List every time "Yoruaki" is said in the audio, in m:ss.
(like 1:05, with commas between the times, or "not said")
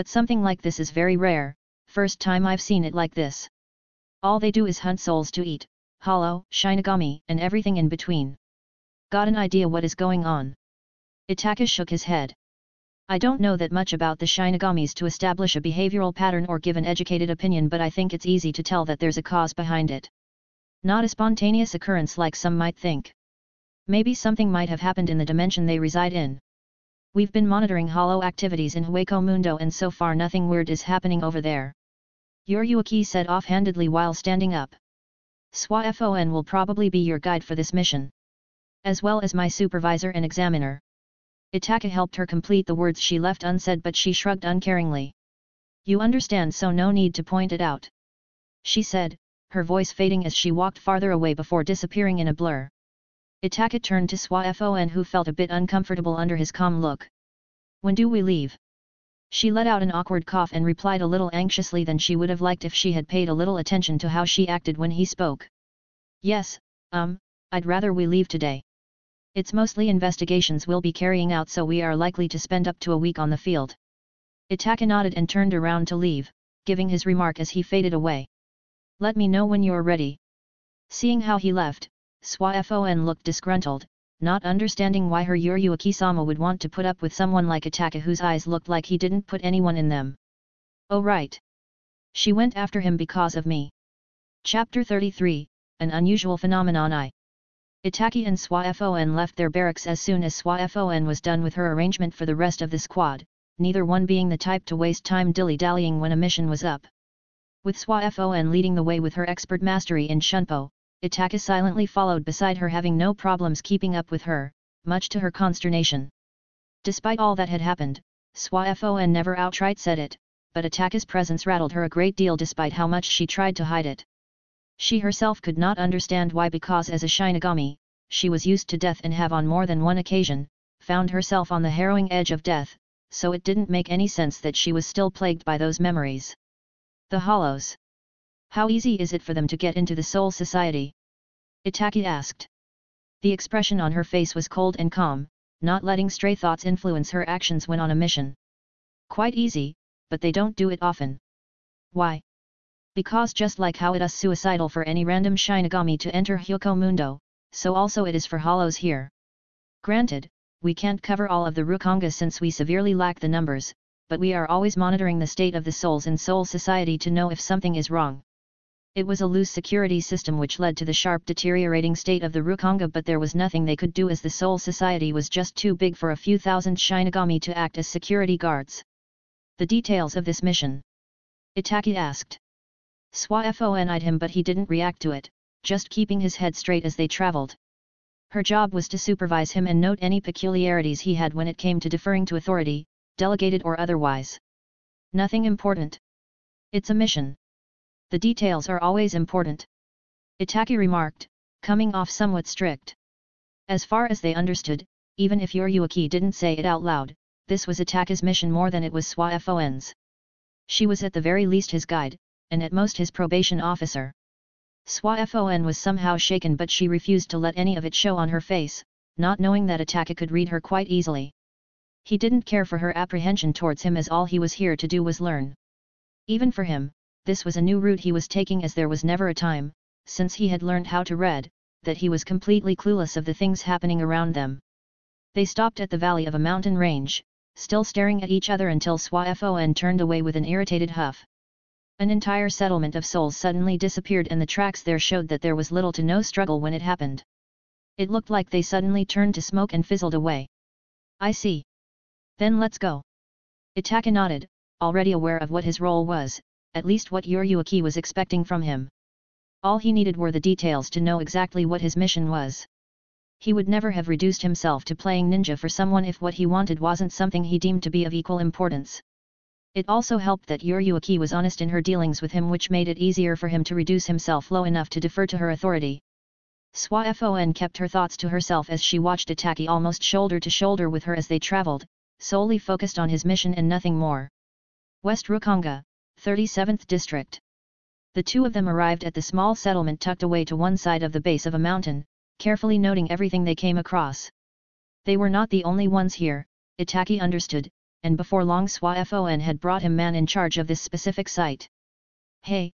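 0:32, 3:25.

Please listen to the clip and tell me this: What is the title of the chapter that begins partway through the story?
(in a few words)
An Unusual Phenomenon.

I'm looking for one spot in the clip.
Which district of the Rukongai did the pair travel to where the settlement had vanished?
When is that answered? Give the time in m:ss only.
4:45.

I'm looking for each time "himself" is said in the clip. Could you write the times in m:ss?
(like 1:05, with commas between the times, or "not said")
4:24, 4:34.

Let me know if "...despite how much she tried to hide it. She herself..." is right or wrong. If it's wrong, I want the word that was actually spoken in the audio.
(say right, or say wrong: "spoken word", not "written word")
right.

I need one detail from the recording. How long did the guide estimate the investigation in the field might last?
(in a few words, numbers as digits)
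Up to a week.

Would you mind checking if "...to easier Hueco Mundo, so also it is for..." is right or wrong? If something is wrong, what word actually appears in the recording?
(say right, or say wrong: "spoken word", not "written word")
wrong: "enter", not "easier".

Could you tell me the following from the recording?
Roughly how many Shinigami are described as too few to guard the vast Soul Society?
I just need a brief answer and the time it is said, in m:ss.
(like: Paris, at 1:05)
A few thousand, at 2:56.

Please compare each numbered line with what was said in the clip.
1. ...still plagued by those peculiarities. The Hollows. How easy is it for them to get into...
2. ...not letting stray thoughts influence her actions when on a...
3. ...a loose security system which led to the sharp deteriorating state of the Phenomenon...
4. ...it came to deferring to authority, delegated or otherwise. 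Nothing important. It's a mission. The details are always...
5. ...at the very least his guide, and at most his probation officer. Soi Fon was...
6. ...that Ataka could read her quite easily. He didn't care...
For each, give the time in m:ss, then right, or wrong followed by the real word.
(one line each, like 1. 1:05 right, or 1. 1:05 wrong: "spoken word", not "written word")
1. 2:14 wrong: "memories", not "peculiarities"
2. 2:25 right
3. 2:49 wrong: "Rukonga", not "Phenomenon"
4. 3:11 right
5. 3:31 right
6. 3:39 right.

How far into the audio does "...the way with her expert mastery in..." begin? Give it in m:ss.
1:48.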